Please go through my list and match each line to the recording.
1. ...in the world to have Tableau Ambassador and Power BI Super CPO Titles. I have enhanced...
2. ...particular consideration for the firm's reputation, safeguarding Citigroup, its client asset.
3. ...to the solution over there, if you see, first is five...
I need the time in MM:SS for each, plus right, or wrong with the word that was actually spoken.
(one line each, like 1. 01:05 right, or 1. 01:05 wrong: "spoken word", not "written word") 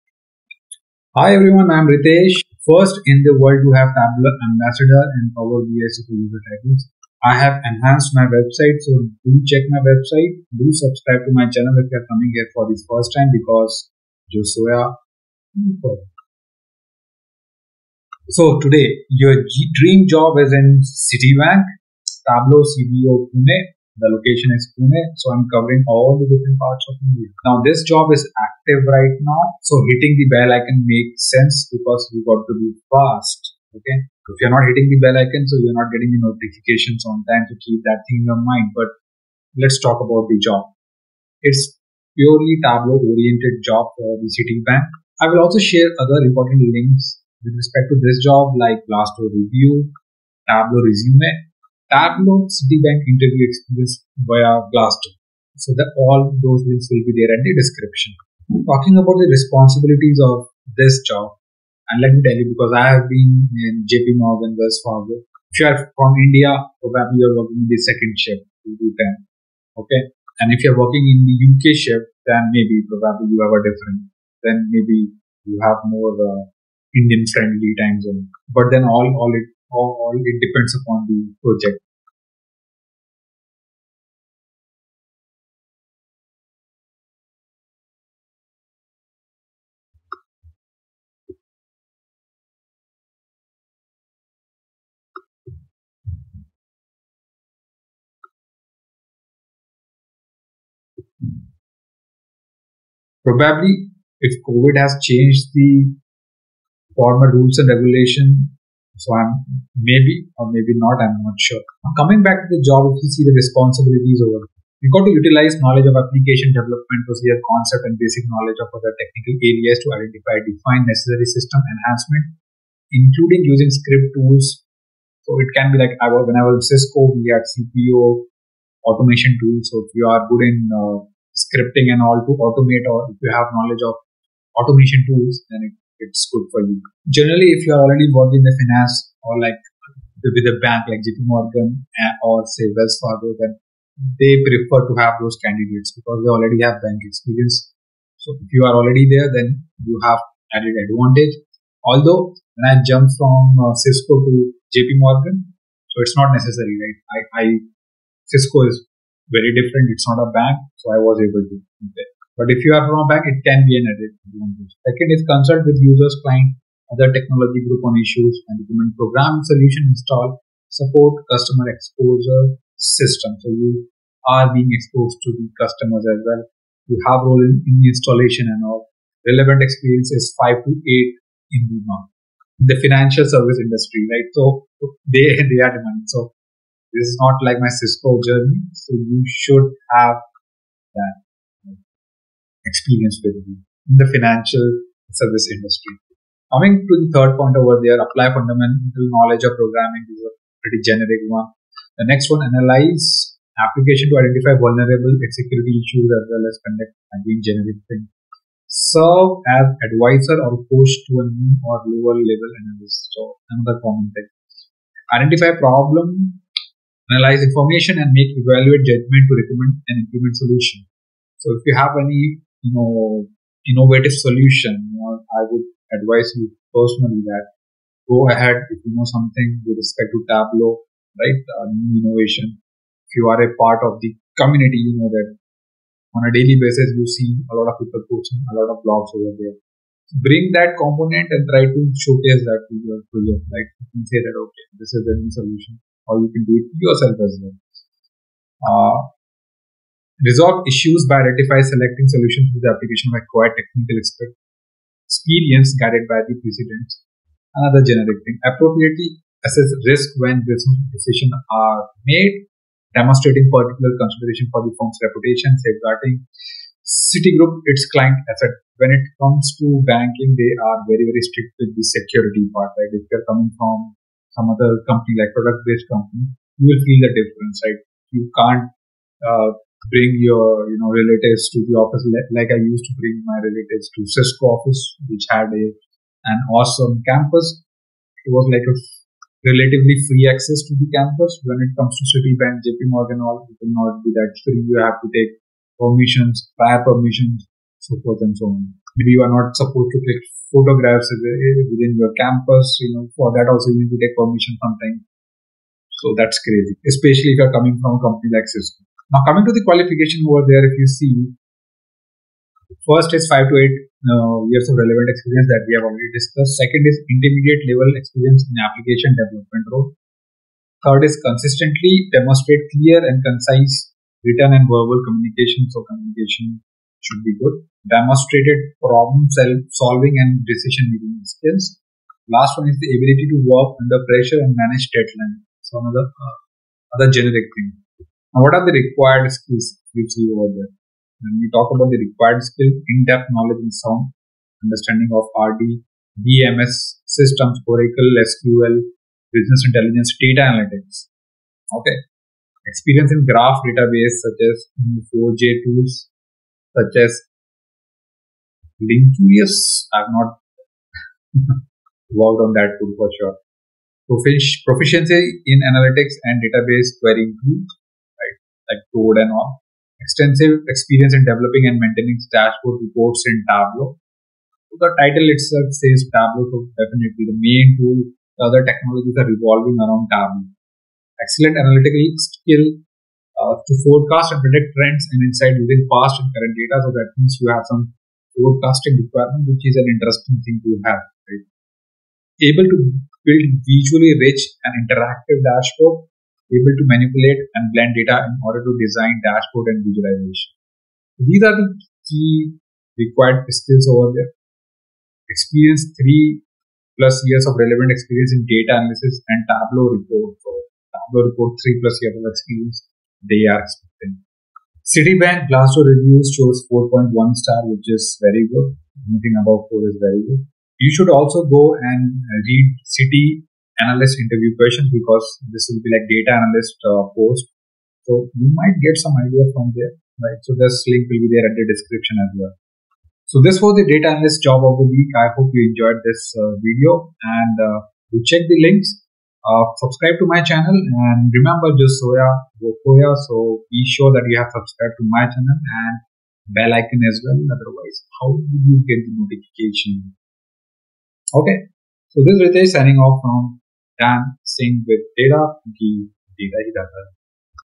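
1. 00:03 wrong: "User", not "CPO"
2. 04:23 right
3. 05:09 wrong: "qualification", not "solution".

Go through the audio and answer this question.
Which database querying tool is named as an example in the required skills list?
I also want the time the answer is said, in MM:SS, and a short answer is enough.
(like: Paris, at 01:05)
Toad, at 06:08.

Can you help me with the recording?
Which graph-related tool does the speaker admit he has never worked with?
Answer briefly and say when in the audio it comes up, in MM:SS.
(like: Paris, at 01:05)
Linkurious, at 05:58.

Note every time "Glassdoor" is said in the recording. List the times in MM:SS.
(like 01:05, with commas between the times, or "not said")
00:48, 00:54, 06:55.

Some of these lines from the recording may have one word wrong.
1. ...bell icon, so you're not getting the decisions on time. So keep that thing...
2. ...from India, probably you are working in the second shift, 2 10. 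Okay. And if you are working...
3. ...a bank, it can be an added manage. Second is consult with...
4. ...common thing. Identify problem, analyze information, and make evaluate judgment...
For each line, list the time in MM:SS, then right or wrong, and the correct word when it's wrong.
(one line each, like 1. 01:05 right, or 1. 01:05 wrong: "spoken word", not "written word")
1. 00:35 wrong: "notifications", not "decisions"
2. 01:05 right
3. 02:43 wrong: "advantage", not "manage"
4. 03:33 right.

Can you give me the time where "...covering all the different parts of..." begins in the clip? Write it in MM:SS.
00:25.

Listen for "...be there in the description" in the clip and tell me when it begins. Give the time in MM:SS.
00:57.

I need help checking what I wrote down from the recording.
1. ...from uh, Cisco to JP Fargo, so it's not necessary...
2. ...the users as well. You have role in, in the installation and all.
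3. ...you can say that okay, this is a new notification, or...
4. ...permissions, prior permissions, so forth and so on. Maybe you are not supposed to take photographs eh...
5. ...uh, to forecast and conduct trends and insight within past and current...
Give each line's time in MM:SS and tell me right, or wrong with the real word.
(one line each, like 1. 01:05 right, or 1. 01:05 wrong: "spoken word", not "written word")
1. 02:33 wrong: "Morgan", not "Fargo"
2. 02:55 wrong: "customers", not "users"
3. 04:03 wrong: "solution", not "notification"
4. 04:55 right
5. 06:23 wrong: "predict", not "conduct".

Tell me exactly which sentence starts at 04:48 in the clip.
It was like a relatively free access to the campus.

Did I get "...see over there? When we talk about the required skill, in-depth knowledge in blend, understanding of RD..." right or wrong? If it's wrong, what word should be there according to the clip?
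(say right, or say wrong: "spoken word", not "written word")
wrong: "sound", not "blend".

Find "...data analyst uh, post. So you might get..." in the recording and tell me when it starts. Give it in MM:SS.
07:06.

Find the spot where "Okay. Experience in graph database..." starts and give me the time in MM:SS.
05:51.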